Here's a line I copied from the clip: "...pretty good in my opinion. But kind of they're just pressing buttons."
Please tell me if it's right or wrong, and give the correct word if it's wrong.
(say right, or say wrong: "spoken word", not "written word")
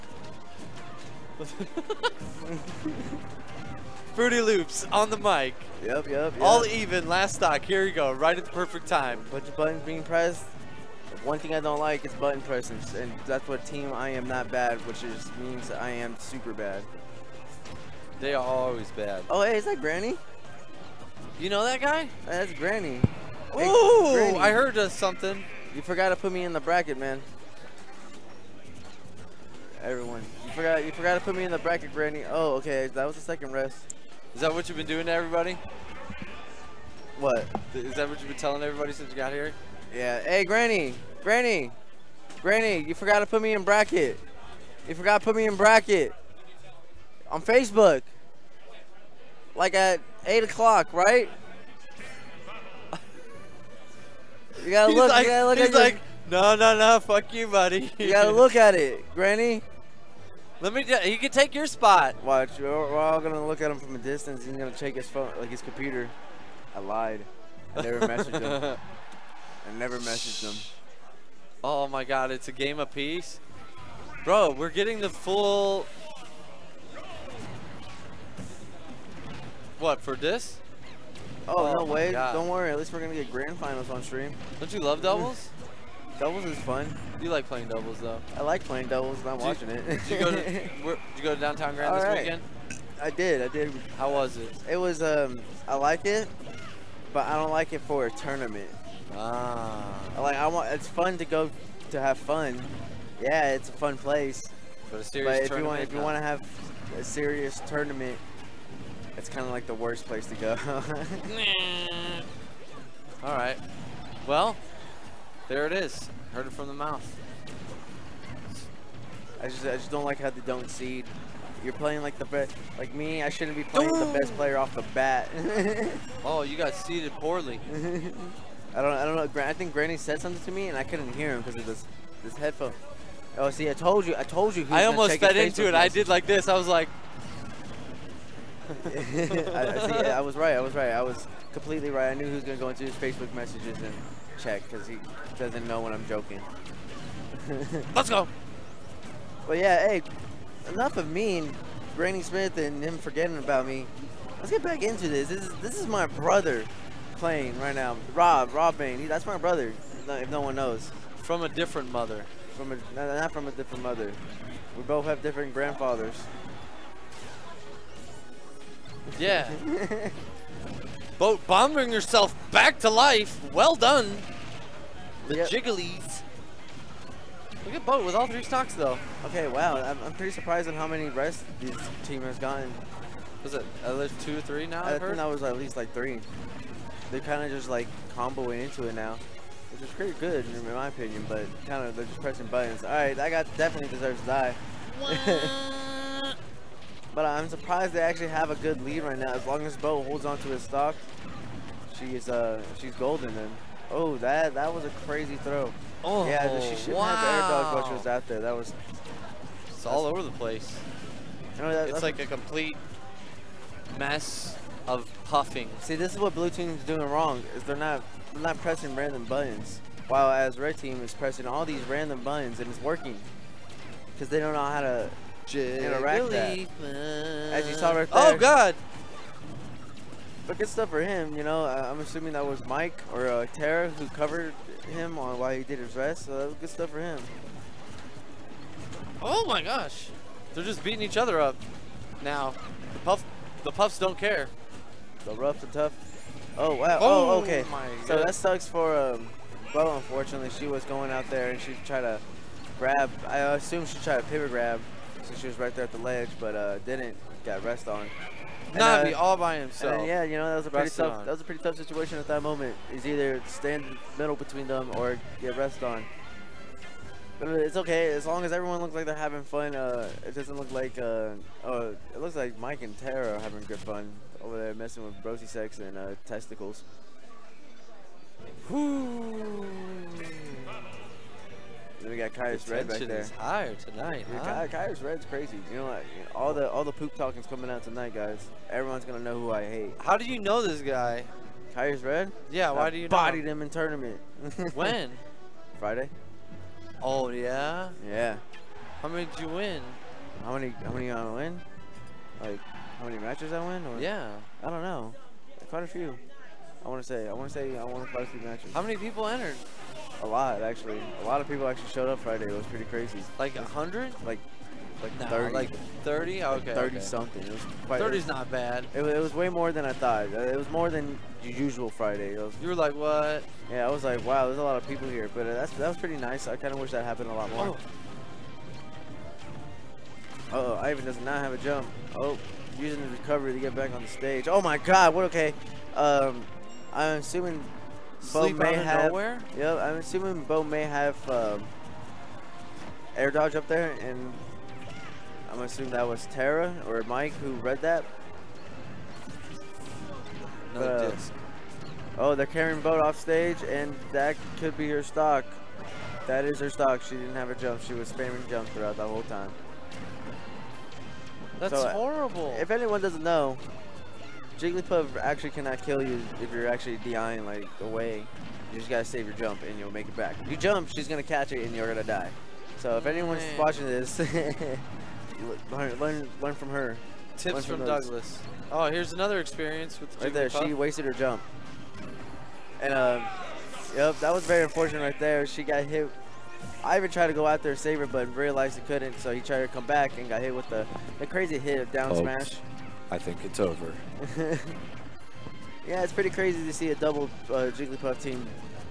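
right.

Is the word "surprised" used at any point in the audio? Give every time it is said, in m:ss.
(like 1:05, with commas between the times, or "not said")
3:00, 3:17.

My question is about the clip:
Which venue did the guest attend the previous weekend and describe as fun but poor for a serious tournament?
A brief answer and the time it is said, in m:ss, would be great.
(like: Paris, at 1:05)
Downtown Grand, at 1:31.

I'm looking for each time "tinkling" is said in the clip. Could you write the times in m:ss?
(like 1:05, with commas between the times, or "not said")
not said.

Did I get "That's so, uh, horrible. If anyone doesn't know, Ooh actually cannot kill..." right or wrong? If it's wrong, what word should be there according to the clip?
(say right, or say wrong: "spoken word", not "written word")
wrong: "Jigglypuff", not "Ooh".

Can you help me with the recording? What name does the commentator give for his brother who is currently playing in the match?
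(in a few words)
Rob Bain.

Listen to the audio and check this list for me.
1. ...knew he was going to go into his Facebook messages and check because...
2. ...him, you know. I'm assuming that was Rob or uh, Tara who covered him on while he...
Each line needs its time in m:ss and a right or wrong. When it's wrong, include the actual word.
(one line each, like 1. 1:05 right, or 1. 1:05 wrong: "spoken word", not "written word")
1. 2:22 right
2. 3:51 wrong: "Mike", not "Rob".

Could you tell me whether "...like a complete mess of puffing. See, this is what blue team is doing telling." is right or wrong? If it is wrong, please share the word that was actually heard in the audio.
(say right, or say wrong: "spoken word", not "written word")
wrong: "wrong", not "telling".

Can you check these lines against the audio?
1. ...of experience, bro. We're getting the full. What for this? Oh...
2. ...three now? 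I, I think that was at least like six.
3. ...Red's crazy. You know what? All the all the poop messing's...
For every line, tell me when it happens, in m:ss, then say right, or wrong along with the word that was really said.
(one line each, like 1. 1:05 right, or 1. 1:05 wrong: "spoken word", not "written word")
1. 1:12 wrong: "peace", not "experience"
2. 3:04 wrong: "three", not "six"
3. 4:45 wrong: "talking", not "messing".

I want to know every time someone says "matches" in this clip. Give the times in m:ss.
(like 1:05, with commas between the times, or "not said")
5:03, 5:08.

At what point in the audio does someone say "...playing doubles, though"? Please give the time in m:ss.
1:27.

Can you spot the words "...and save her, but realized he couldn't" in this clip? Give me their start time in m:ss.
6:27.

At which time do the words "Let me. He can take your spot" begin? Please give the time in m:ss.
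1:00.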